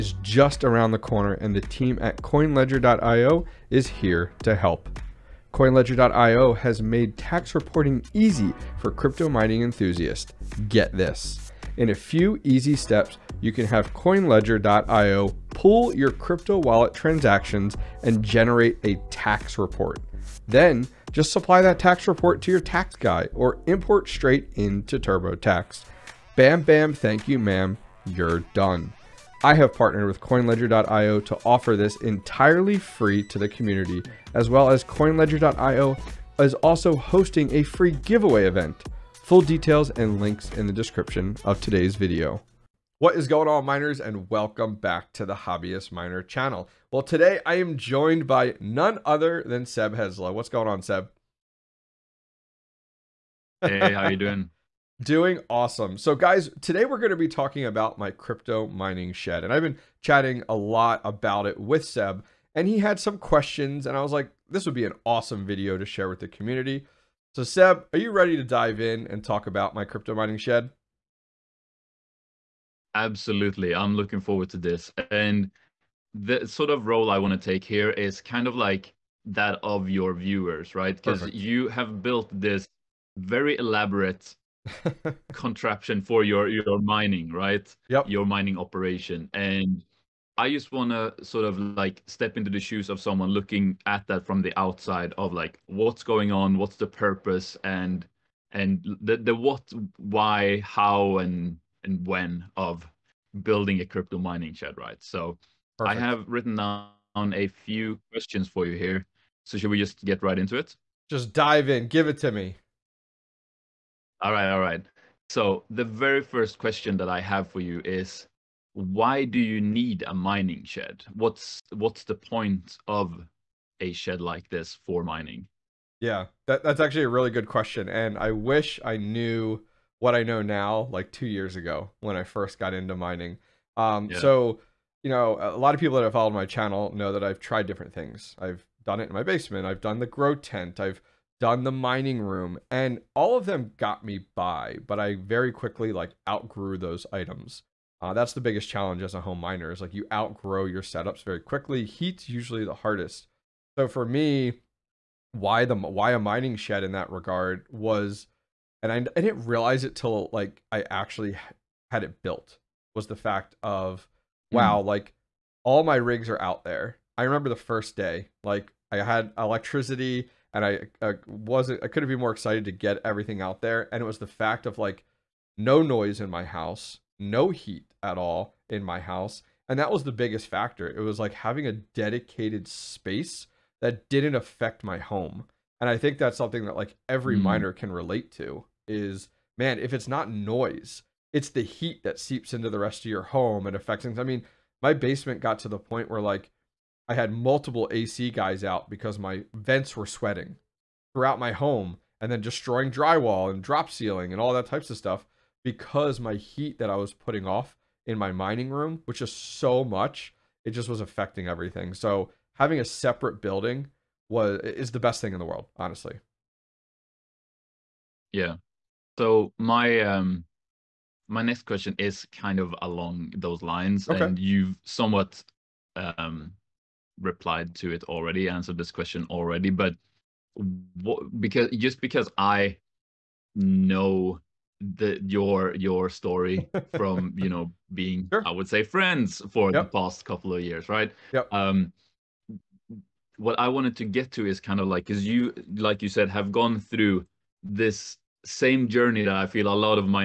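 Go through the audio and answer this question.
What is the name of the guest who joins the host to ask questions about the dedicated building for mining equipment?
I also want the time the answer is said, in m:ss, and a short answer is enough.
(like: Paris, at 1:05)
Seb Hesla, at 0:49.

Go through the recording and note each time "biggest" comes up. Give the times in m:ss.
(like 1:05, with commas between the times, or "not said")
2:28, 3:00.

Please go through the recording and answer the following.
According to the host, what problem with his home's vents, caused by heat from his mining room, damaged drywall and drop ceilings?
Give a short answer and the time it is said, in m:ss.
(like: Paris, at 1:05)
sweating, at 3:20.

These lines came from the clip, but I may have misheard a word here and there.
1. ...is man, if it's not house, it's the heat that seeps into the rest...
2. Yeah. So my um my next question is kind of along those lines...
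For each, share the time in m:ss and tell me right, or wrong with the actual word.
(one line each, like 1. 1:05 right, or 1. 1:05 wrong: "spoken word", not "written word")
1. 3:08 wrong: "noise", not "house"
2. 3:38 right.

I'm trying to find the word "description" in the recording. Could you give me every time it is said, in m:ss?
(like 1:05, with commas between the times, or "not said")
0:40.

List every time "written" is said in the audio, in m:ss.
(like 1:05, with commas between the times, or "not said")
1:46.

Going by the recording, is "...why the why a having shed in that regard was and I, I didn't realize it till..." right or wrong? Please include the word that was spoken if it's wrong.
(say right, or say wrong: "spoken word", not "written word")
wrong: "mining", not "having".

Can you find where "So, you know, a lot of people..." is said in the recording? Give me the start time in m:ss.
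2:14.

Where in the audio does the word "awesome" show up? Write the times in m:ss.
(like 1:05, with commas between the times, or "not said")
0:55, 1:05.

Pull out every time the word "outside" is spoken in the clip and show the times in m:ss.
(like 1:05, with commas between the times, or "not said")
1:34.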